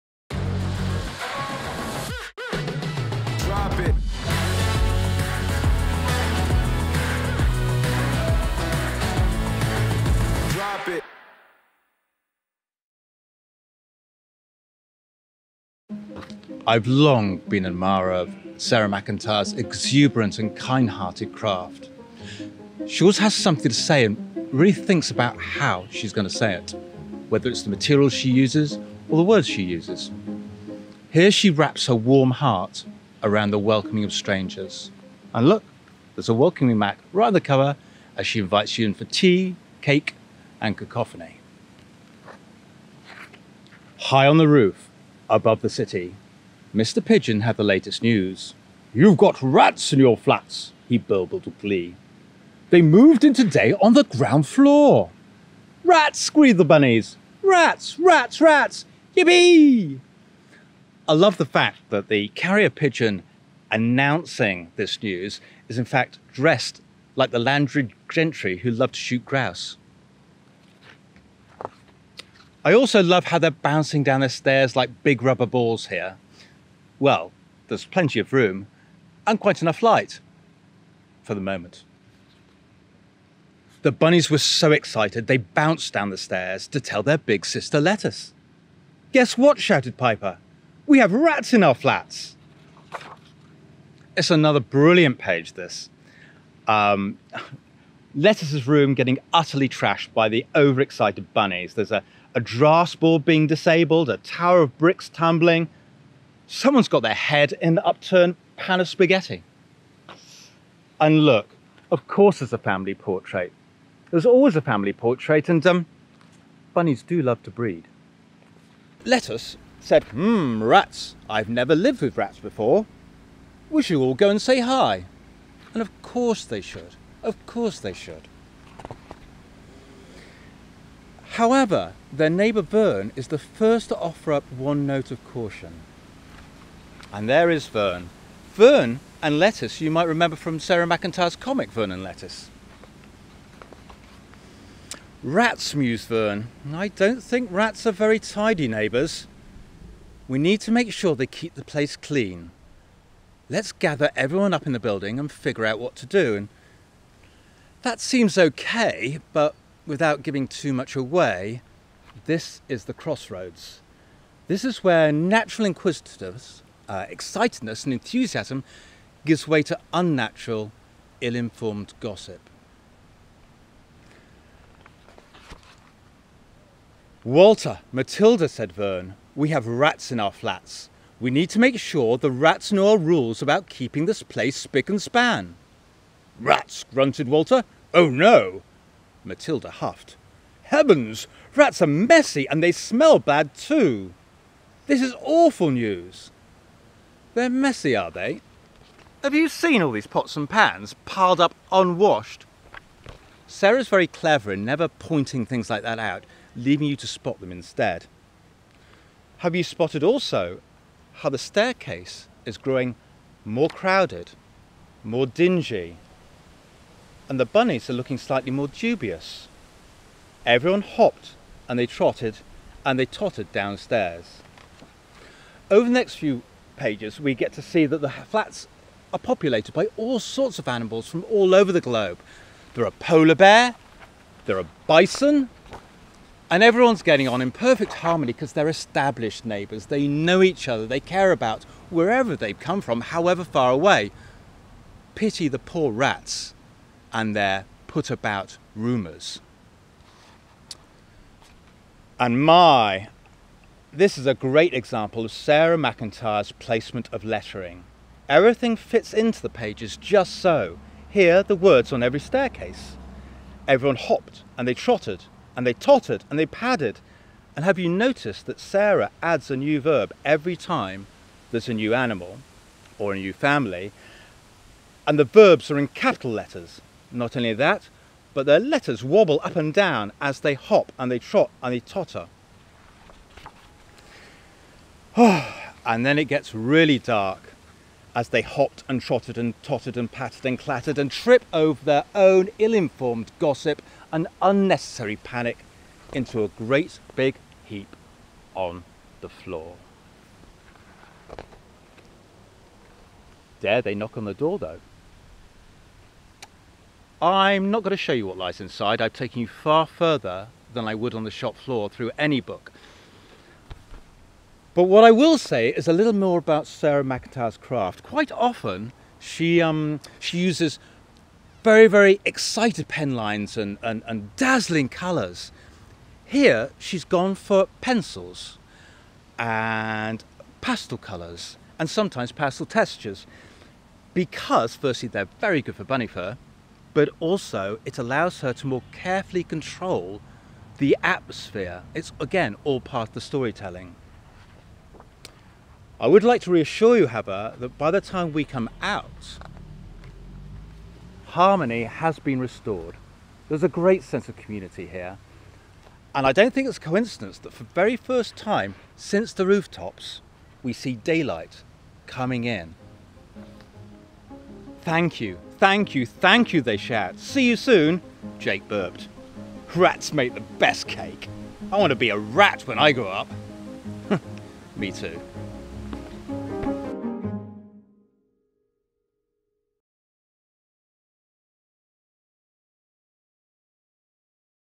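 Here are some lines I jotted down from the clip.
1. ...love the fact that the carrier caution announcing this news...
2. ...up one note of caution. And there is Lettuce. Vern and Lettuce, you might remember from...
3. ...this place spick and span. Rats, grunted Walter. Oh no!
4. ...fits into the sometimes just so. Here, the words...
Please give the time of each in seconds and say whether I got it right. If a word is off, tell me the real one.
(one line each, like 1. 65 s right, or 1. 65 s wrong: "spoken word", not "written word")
1. 61 s wrong: "pigeon", not "caution"
2. 134 s wrong: "Vern", not "Lettuce"
3. 184 s right
4. 258 s wrong: "pages", not "sometimes".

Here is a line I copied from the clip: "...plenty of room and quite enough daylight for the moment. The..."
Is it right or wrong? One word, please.
wrong.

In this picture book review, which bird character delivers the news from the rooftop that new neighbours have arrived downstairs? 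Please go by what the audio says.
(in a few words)
Mr. Pigeon.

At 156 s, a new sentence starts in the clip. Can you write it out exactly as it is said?
And that seems okay, but without giving too much away, this is the crossroads.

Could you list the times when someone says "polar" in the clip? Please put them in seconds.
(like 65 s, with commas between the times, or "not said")
232 s.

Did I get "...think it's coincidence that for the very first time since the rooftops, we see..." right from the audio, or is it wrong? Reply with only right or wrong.
right.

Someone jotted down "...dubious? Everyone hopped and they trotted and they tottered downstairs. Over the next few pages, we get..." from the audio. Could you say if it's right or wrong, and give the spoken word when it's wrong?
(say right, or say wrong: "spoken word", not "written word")
right.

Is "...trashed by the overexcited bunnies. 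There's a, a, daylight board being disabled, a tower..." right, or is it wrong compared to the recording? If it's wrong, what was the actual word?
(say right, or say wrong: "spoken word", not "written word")
wrong: "draught", not "daylight".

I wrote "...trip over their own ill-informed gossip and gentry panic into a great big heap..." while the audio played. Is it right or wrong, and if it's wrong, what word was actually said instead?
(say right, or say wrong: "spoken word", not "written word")
wrong: "unnecessary", not "gentry".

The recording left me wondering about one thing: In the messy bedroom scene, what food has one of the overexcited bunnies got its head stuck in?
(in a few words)
spaghetti.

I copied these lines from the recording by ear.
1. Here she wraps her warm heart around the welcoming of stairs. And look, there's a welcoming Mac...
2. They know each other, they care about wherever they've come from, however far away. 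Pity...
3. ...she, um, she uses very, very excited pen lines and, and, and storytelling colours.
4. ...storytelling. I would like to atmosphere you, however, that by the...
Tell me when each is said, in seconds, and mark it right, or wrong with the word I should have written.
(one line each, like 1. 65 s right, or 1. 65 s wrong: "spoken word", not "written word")
1. 31 s wrong: "strangers", not "stairs"
2. 239 s right
3. 319 s wrong: "dazzling", not "storytelling"
4. 343 s wrong: "reassure", not "atmosphere".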